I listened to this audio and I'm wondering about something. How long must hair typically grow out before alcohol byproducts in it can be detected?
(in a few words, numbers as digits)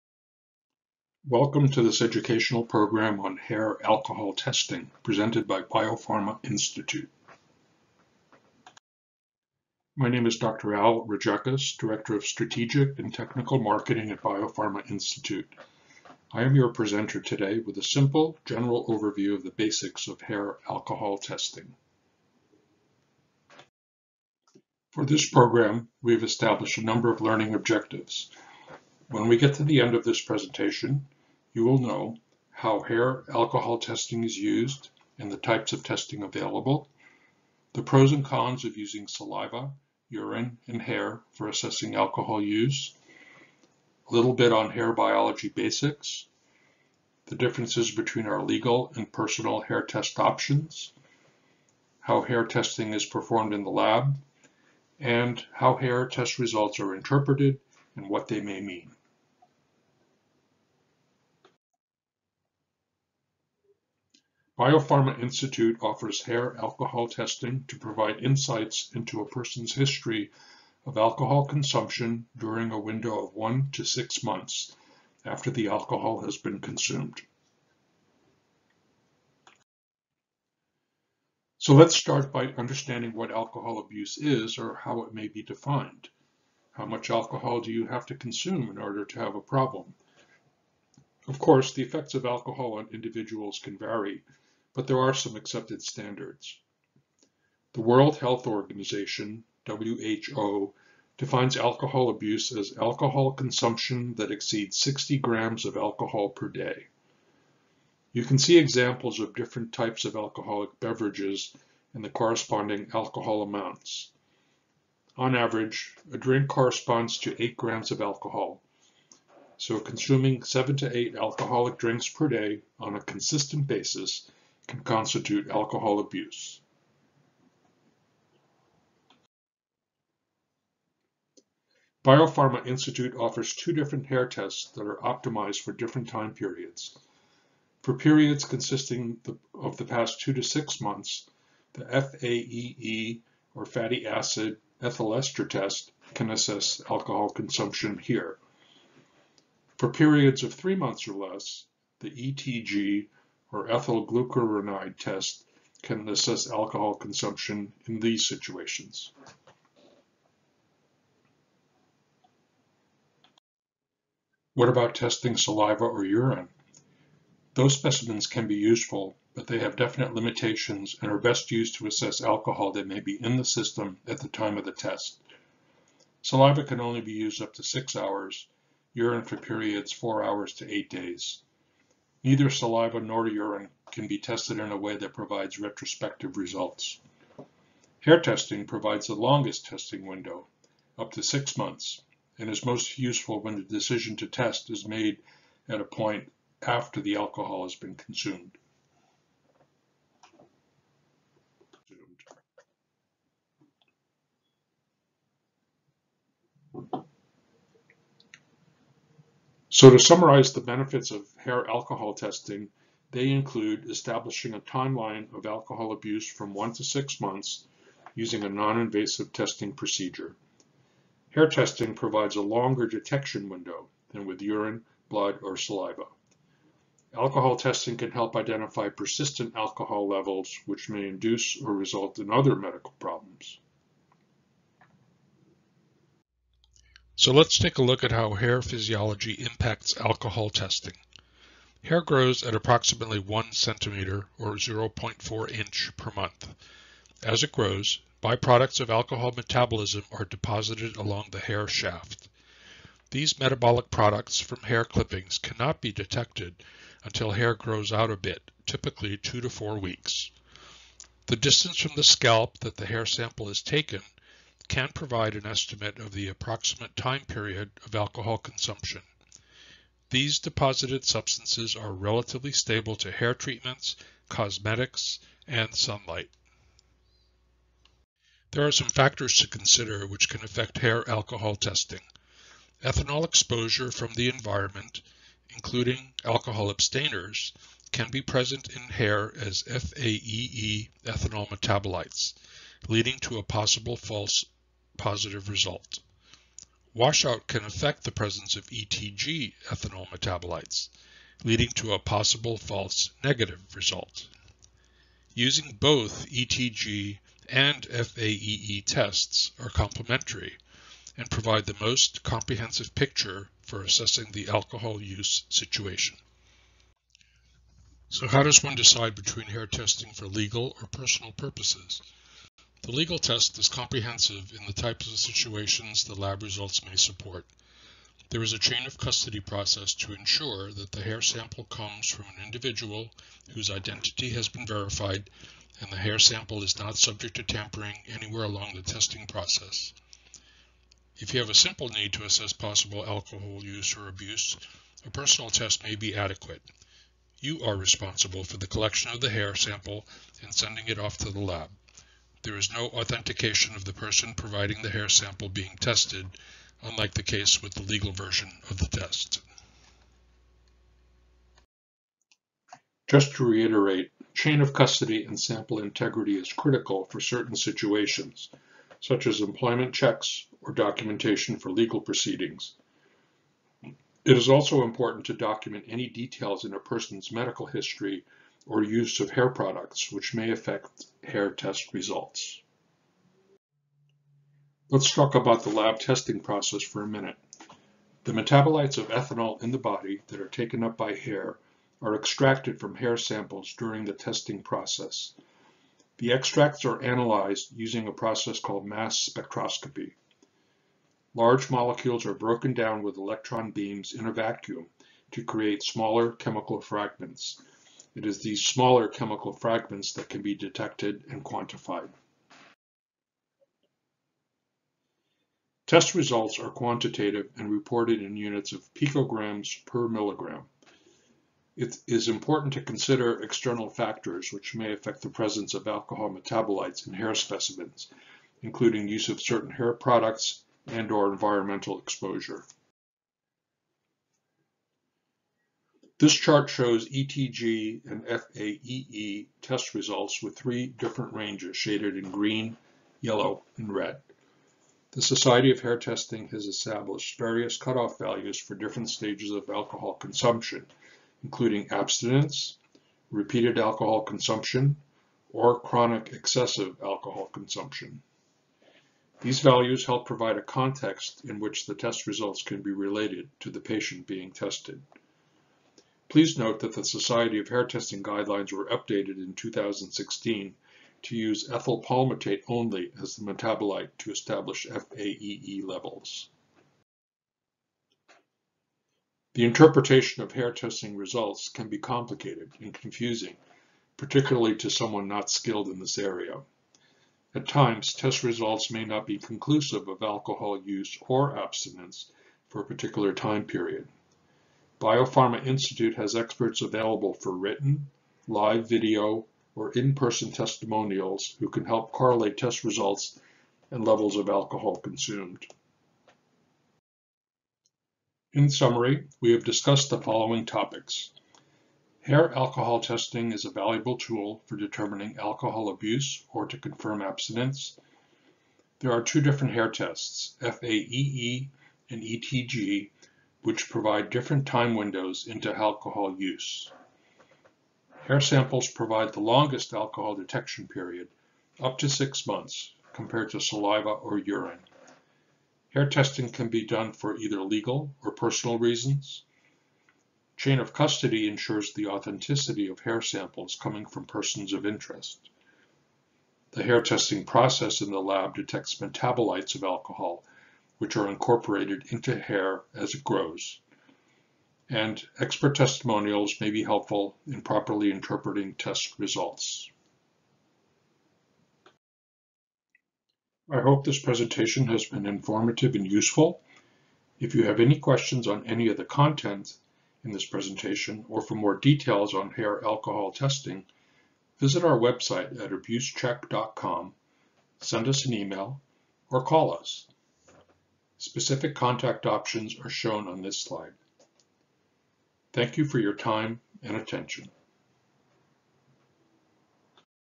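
2 to 4 weeks.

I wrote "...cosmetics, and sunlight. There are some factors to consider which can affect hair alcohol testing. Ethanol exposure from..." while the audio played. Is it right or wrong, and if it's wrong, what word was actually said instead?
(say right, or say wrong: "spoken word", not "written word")
right.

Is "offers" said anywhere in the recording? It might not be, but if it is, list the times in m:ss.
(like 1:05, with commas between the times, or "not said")
1:05, 2:13.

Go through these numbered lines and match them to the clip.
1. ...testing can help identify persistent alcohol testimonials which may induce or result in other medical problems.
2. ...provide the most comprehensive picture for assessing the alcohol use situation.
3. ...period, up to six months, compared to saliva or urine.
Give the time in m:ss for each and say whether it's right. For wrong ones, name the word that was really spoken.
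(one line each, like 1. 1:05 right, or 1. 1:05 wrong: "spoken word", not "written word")
1. 3:47 wrong: "levels", not "testimonials"
2. 5:11 right
3. 8:50 right.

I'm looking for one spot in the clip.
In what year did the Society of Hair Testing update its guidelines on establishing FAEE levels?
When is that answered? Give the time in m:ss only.
7:49.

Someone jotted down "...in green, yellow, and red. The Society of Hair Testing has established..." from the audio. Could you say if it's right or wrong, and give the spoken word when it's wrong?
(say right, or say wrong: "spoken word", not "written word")
right.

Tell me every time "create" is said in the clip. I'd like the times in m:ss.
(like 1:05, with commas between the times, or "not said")
6:45.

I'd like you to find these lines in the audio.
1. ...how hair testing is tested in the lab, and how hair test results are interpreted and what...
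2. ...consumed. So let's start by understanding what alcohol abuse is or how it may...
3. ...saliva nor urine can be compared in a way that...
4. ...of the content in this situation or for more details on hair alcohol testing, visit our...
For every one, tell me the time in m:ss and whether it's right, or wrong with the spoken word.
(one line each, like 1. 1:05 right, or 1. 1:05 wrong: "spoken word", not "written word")
1. 0:51 wrong: "performed", not "tested"
2. 1:16 right
3. 3:02 wrong: "tested", not "compared"
4. 9:28 wrong: "presentation", not "situation".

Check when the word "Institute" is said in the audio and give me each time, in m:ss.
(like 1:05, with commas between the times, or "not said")
0:06, 0:14, 1:05, 2:12, 8:15.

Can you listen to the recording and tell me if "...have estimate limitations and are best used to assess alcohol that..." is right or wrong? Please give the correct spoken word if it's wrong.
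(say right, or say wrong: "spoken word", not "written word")
wrong: "definite", not "estimate".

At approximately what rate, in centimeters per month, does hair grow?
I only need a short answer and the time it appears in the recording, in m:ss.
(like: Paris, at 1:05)
1 centimeter, at 4:03.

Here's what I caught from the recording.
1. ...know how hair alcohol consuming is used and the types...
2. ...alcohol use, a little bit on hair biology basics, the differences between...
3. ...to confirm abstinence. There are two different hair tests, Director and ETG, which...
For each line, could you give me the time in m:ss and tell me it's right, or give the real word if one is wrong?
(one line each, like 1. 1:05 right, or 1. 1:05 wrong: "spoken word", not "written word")
1. 0:31 wrong: "testing", not "consuming"
2. 0:41 right
3. 8:36 wrong: "FAEE", not "Director".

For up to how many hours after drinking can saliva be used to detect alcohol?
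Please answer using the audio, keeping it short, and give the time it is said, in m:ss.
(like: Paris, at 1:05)
6 hours, at 2:57.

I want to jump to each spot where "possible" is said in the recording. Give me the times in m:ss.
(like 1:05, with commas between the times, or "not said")
4:53, 5:01, 5:42.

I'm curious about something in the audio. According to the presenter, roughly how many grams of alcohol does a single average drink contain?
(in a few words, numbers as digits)
8 grams.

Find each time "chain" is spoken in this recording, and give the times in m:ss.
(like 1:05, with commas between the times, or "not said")
5:28, 6:04, 9:00.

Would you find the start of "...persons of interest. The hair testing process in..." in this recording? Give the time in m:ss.
9:04.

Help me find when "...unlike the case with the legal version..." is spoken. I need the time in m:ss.
5:56.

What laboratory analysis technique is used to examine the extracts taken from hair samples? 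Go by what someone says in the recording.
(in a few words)
mass spectroscopy.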